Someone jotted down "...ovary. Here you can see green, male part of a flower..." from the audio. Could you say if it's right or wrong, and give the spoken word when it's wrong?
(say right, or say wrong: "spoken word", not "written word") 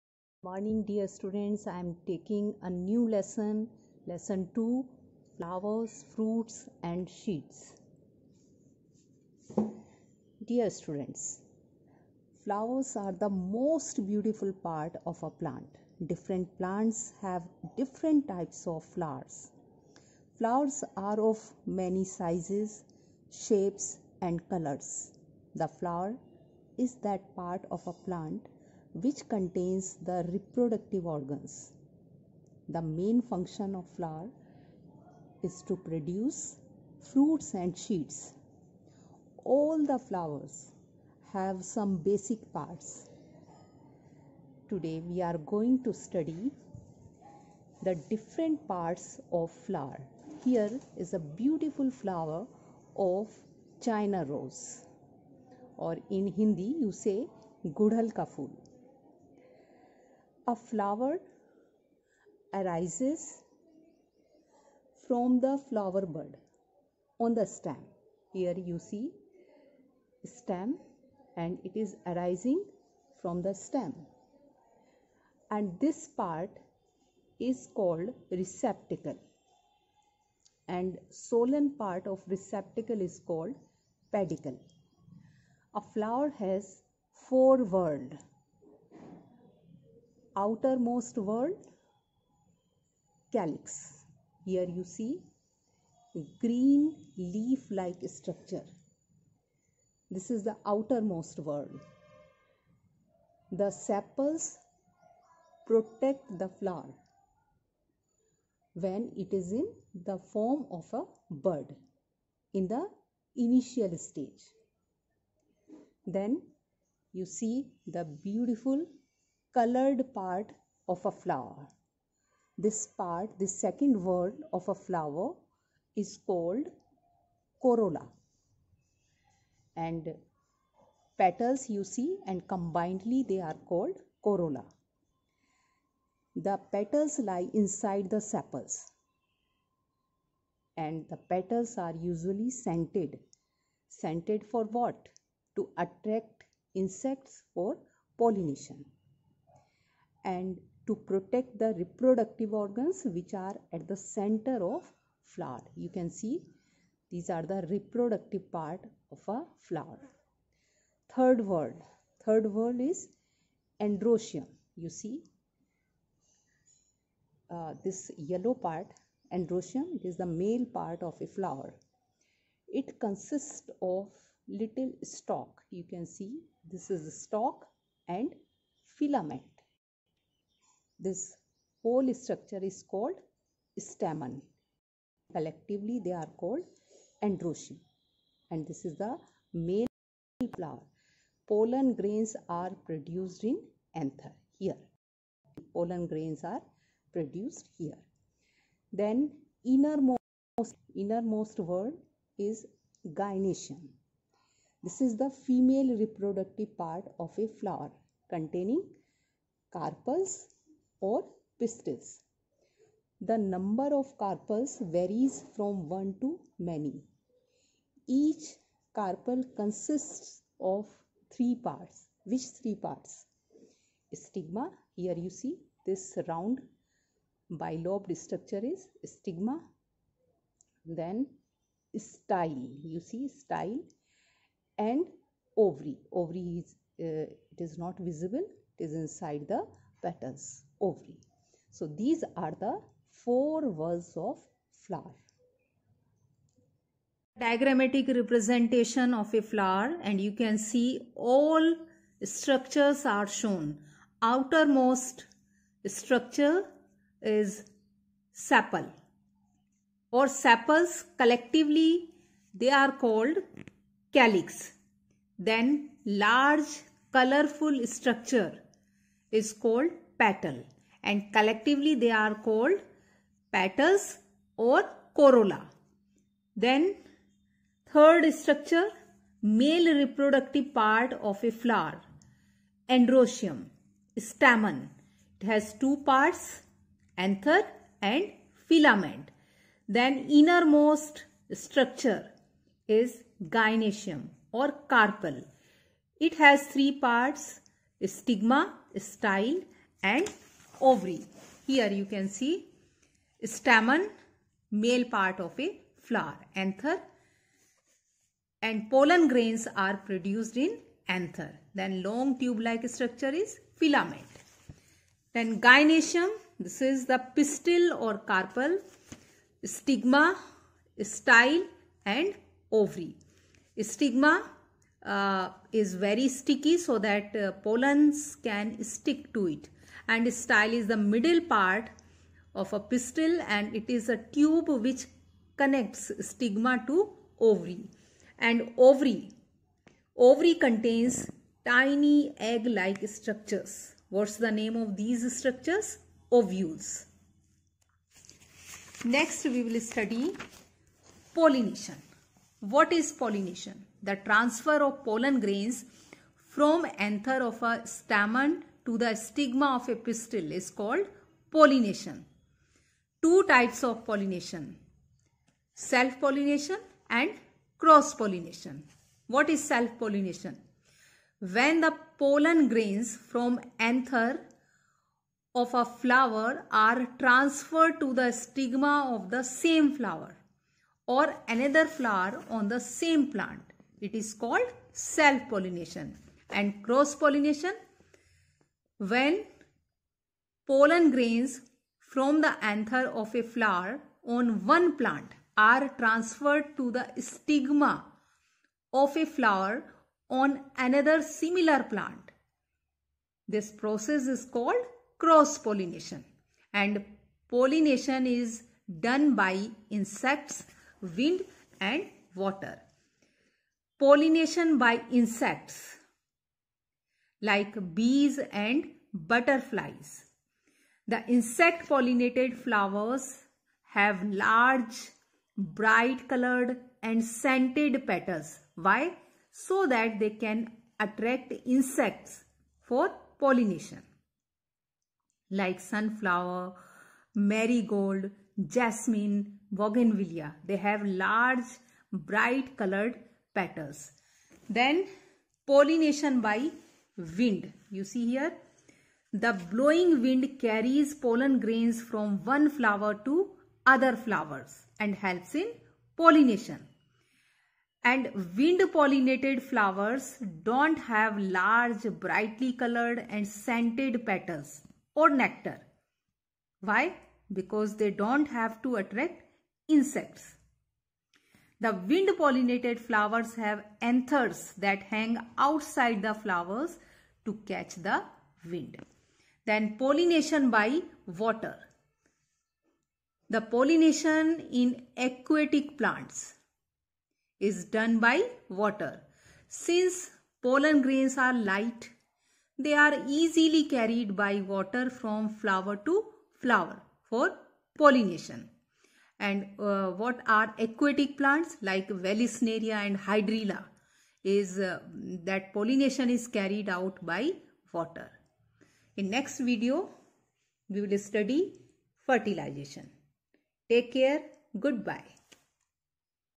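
wrong: "stamen", not "green".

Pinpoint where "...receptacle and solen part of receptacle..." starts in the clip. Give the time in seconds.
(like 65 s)
78 s.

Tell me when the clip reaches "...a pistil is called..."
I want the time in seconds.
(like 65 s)
359 s.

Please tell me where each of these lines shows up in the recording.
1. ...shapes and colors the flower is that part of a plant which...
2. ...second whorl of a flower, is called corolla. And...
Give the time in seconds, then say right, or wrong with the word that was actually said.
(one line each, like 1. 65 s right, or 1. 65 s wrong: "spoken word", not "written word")
1. 23 s right
2. 123 s right.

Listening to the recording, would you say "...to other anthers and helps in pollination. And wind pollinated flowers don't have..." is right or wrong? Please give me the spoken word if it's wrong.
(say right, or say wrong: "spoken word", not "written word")
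wrong: "flowers", not "anthers".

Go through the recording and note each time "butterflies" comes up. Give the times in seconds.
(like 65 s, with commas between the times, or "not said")
419 s.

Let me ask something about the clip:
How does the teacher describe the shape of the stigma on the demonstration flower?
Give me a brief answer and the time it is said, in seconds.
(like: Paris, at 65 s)
round bilobed, at 226 s.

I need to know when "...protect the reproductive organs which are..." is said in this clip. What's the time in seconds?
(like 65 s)
150 s.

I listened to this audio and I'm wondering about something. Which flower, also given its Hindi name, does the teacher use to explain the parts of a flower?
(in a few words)
China rose.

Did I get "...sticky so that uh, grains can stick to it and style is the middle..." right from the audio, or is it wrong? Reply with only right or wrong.
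wrong.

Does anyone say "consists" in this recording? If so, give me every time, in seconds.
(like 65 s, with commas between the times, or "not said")
173 s, 219 s.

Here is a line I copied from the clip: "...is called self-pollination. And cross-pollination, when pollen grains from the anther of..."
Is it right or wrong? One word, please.
right.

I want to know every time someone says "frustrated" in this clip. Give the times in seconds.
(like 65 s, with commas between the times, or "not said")
not said.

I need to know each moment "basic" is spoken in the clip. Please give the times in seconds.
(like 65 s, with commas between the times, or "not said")
41 s.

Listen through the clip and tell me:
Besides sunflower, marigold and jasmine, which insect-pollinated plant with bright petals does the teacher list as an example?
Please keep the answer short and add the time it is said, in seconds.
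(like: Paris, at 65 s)
bougainvillea, at 439 s.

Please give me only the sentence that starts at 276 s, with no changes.
Then third structure male reproductive part of a flower androecium, stamen.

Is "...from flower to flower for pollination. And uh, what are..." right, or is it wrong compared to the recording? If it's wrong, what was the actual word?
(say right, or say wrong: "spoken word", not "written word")
right.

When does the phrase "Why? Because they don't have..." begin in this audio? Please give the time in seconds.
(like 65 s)
466 s.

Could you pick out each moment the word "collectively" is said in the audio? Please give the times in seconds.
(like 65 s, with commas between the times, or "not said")
185 s, 261 s, 271 s.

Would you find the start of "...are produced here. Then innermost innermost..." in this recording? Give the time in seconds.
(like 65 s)
196 s.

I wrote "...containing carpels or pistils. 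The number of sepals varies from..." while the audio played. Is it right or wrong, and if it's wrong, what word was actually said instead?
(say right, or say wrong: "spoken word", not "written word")
wrong: "carpels", not "sepals".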